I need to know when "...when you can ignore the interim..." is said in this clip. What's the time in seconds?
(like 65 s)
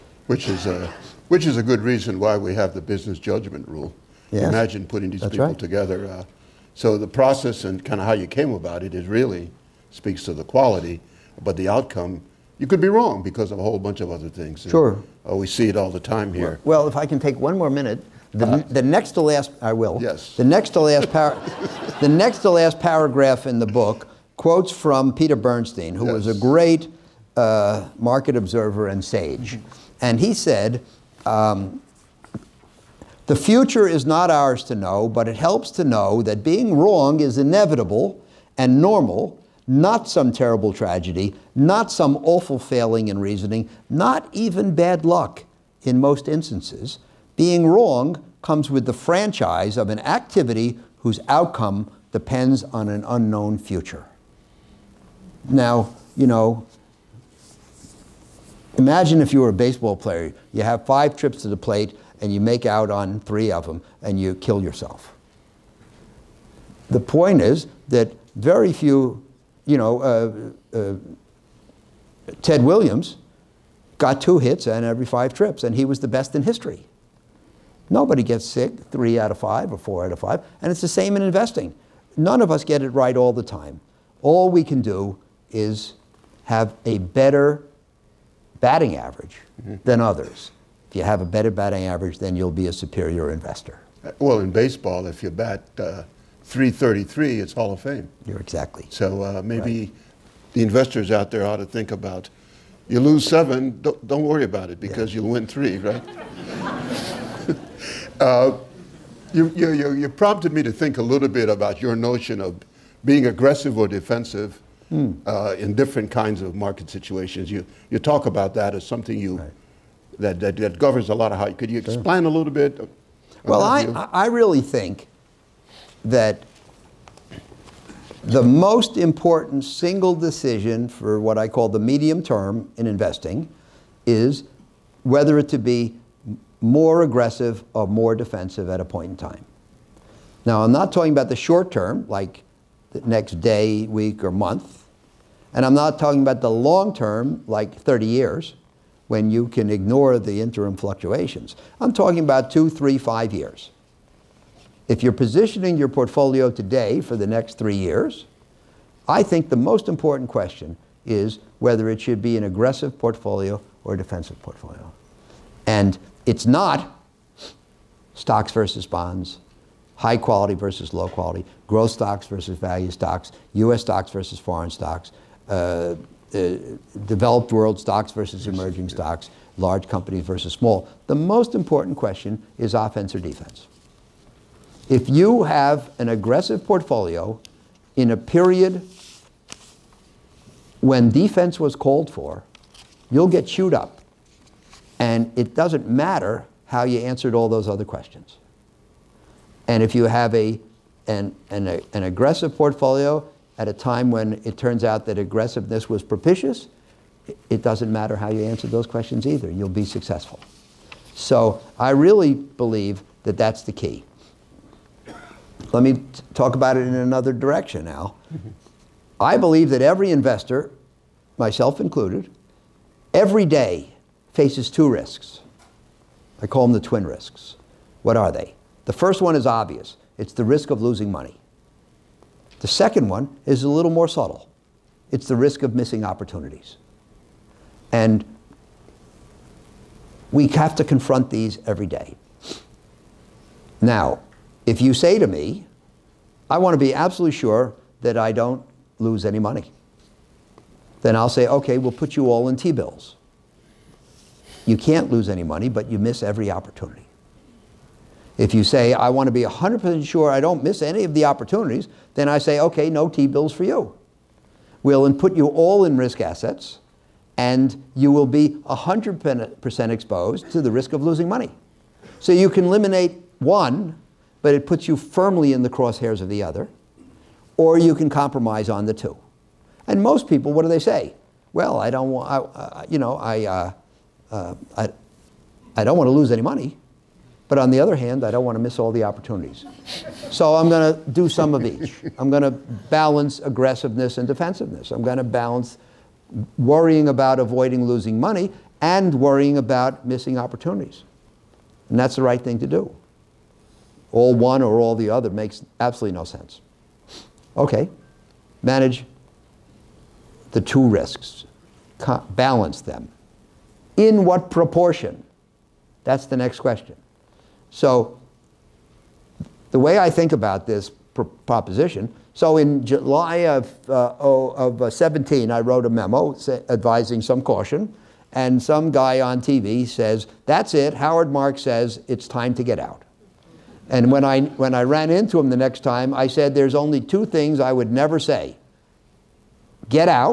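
149 s.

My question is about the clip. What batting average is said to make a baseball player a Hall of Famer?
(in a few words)
333.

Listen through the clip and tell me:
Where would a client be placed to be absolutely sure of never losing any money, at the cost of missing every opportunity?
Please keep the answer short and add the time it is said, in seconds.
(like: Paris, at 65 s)
T-bills, at 252 s.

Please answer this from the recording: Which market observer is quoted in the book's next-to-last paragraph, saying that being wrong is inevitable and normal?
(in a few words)
Peter Bernstein.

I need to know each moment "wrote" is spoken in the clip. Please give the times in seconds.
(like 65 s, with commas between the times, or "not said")
325 s.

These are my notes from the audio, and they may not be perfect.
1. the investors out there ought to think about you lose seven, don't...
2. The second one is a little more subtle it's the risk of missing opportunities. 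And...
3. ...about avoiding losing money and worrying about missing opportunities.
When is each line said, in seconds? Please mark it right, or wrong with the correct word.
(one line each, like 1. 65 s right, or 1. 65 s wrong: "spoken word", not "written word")
1. 100 s right
2. 232 s right
3. 297 s right.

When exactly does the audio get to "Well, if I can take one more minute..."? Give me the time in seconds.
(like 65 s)
16 s.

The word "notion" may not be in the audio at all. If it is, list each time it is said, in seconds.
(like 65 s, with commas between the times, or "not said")
111 s.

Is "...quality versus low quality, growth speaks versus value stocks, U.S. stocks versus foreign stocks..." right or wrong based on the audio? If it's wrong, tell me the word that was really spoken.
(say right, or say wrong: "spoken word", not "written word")
wrong: "stocks", not "speaks".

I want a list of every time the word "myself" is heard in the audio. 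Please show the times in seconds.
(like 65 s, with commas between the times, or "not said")
221 s.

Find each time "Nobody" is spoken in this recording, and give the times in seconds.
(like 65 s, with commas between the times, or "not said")
77 s.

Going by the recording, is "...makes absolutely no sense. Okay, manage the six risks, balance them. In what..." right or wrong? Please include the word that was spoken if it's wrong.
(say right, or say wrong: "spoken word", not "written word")
wrong: "two", not "six".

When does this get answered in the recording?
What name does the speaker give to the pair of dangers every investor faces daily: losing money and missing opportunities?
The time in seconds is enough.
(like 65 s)
226 s.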